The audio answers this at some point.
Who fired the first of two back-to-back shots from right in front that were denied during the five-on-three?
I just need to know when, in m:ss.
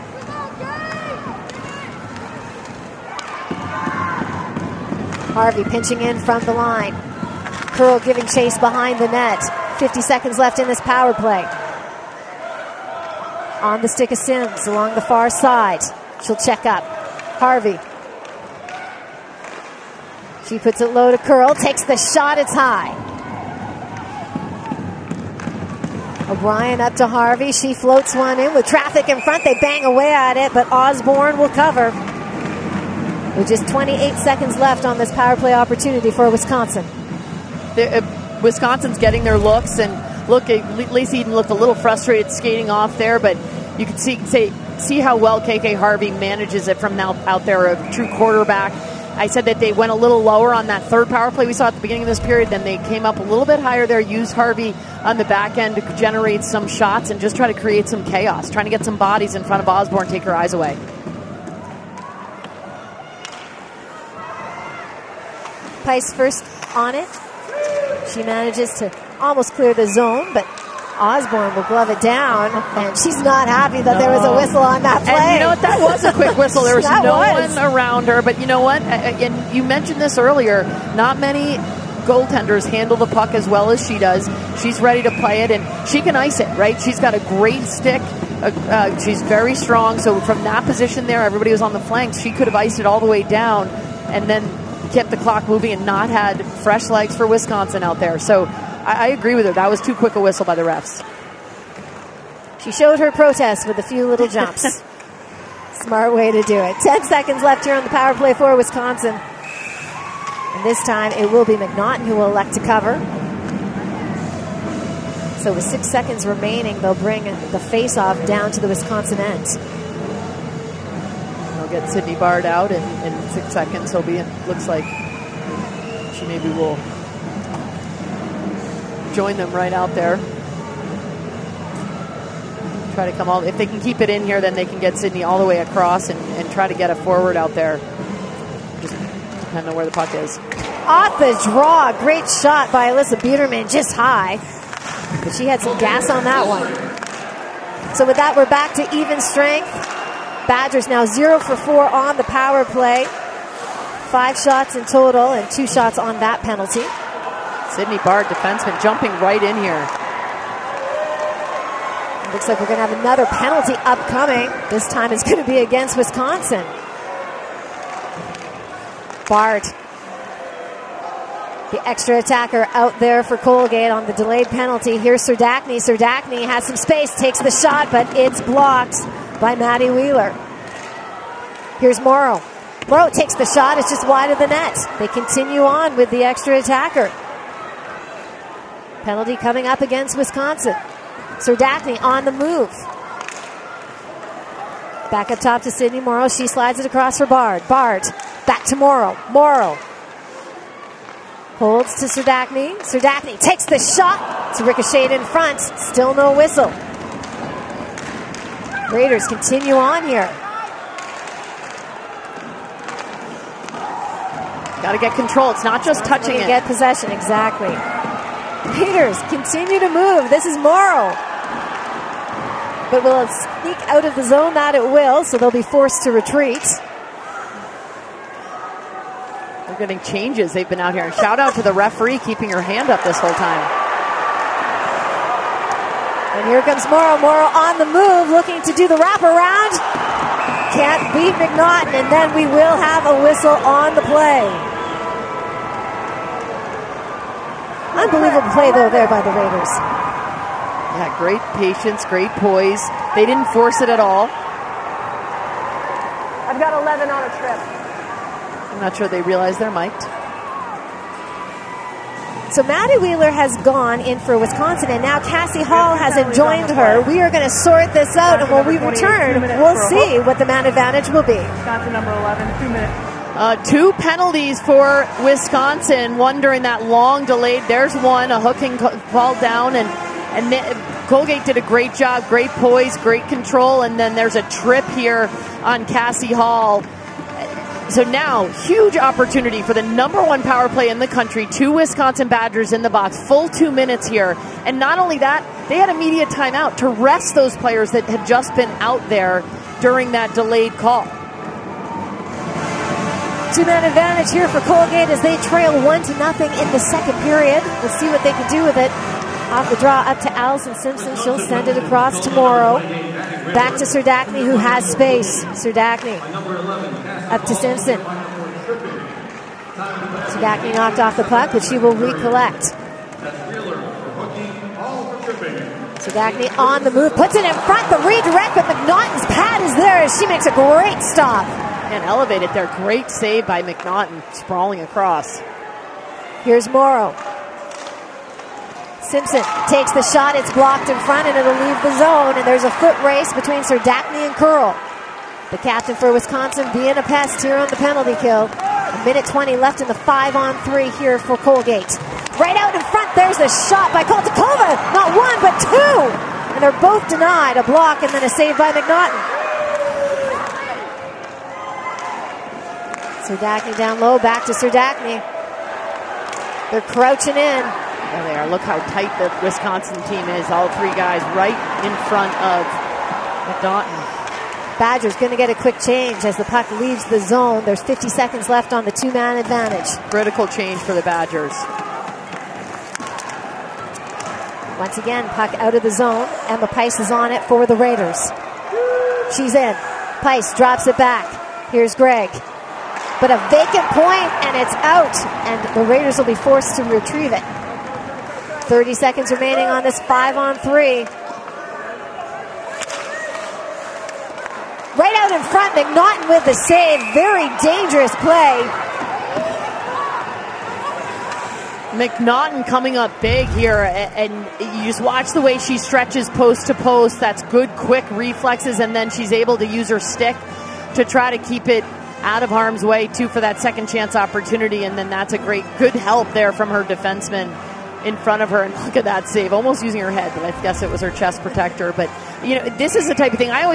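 5:54.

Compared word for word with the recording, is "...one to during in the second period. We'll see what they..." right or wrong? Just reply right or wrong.
wrong.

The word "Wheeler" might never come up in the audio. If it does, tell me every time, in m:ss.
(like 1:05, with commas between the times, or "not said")
2:59, 4:22.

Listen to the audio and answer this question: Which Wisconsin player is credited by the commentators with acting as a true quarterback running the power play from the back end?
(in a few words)
KK Harvey.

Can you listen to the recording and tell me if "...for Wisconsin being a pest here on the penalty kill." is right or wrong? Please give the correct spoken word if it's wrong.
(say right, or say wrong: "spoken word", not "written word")
right.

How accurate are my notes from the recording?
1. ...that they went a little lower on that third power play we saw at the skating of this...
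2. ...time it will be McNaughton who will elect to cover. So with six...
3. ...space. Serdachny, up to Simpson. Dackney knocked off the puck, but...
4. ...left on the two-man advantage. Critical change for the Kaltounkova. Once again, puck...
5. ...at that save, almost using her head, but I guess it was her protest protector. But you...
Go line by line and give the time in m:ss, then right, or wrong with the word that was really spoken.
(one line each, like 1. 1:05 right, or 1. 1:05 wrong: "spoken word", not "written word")
1. 0:49 wrong: "beginning", not "skating"
2. 1:50 right
3. 5:14 right
4. 6:18 wrong: "Badgers", not "Kaltounkova"
5. 7:08 wrong: "chest", not "protest".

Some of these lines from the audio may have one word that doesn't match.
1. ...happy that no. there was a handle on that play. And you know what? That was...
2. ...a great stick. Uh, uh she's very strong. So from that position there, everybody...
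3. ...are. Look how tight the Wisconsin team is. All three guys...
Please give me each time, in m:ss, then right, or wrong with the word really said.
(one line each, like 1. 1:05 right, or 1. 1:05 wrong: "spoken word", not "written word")
1. 1:13 wrong: "whistle", not "handle"
2. 1:27 right
3. 6:08 right.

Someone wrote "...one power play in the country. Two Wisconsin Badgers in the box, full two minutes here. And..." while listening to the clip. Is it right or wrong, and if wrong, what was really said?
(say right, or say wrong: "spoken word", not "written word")
right.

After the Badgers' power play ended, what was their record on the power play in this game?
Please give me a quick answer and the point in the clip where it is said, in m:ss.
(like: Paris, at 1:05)
0 for 4, at 2:31.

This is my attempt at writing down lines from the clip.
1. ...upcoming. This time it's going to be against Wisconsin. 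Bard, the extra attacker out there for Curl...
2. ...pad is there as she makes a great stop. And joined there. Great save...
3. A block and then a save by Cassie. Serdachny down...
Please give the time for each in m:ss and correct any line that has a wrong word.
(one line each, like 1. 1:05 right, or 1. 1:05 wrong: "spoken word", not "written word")
1. 2:43 wrong: "Colgate", not "Curl"
2. 5:29 wrong: "elevated", not "joined"
3. 5:57 wrong: "McNaughton", not "Cassie".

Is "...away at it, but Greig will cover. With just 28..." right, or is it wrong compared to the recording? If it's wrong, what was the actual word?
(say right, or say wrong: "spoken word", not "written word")
wrong: "Osborne", not "Greig".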